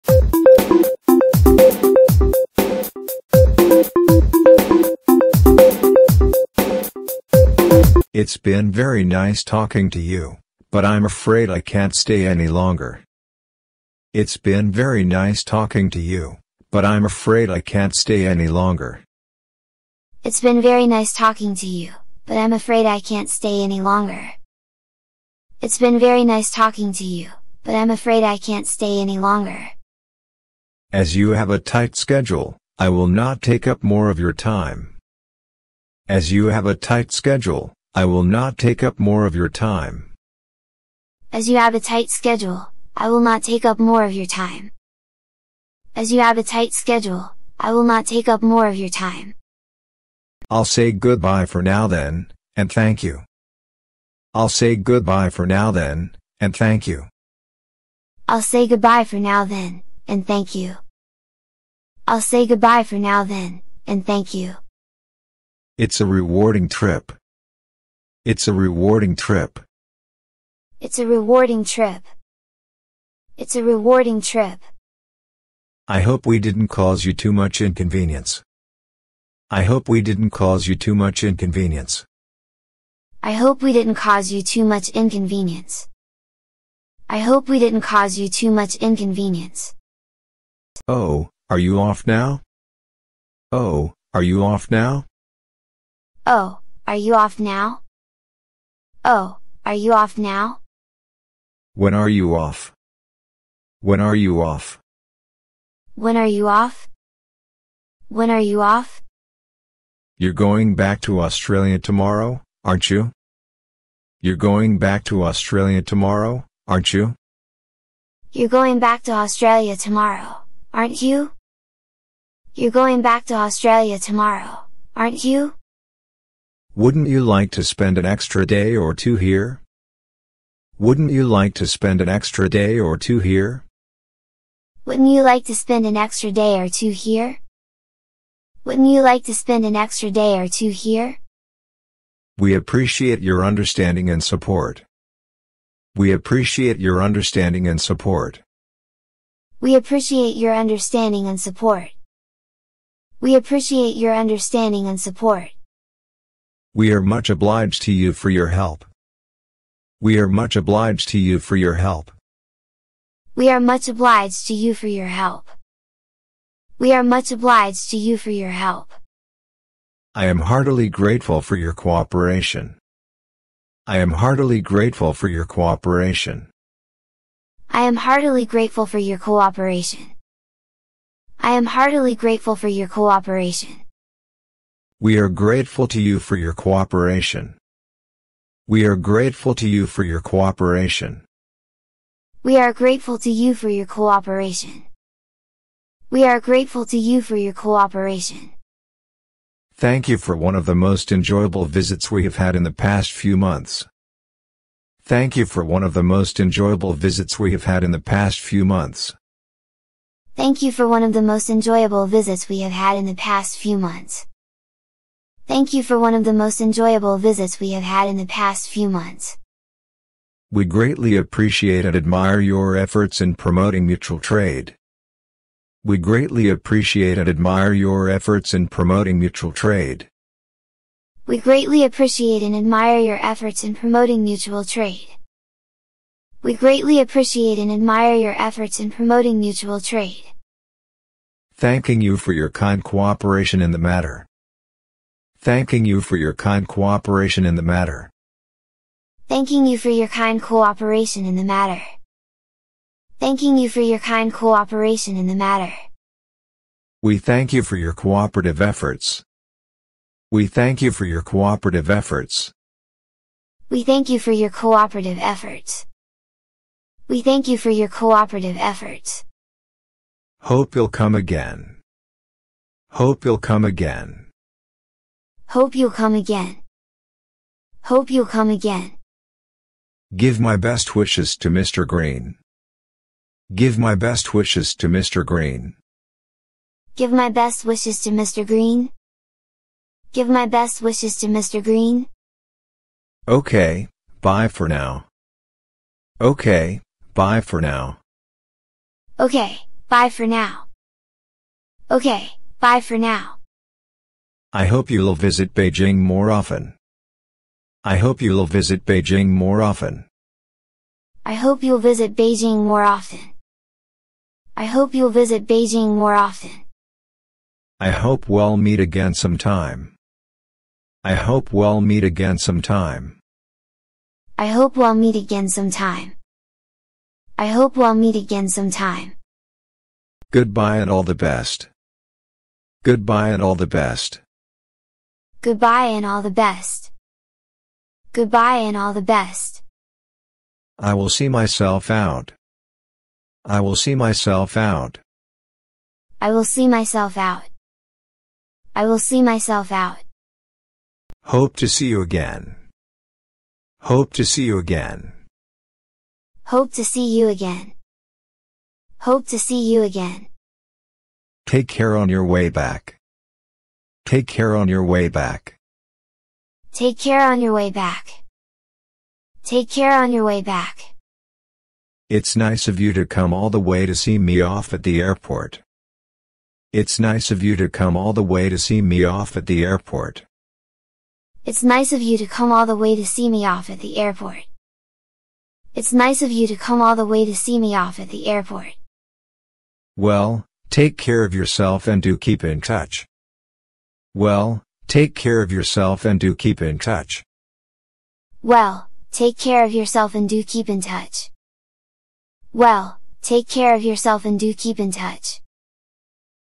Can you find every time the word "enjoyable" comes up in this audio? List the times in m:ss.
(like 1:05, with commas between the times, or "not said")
3:21, 3:26, 3:31, 3:36.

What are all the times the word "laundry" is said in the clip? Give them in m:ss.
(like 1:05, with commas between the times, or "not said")
not said.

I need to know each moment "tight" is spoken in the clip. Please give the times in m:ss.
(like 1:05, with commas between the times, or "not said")
0:31, 0:36, 0:41, 0:46.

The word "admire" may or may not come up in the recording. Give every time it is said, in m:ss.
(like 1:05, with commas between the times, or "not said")
3:41, 3:47, 3:52, 3:57.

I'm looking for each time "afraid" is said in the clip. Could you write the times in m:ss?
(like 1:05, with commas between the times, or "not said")
0:11, 0:17, 0:22, 0:27.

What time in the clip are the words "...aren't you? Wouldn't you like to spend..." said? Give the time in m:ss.
2:04.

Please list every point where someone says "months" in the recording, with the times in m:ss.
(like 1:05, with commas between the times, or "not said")
3:23, 3:28, 3:33, 3:38.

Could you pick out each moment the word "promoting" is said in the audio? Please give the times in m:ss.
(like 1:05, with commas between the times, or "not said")
3:43, 3:48, 3:53, 3:58.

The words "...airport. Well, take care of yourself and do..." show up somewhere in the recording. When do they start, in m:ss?
6:28.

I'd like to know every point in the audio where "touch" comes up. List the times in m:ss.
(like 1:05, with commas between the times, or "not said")
6:32, 6:36, 6:40, 6:44.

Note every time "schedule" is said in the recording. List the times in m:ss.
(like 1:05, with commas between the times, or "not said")
0:31, 0:37, 0:42, 0:46.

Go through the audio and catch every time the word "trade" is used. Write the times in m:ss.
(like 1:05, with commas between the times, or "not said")
3:44, 3:49, 3:54, 3:59.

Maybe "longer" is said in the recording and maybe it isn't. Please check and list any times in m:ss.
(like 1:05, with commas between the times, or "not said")
0:12, 0:18, 0:23, 0:29.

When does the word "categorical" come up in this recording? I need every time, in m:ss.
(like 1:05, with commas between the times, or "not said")
not said.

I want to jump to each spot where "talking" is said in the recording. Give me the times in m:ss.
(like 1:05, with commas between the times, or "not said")
0:09, 0:15, 0:21, 0:26.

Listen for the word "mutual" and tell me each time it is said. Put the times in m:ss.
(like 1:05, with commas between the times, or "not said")
3:43, 3:49, 3:54, 3:59.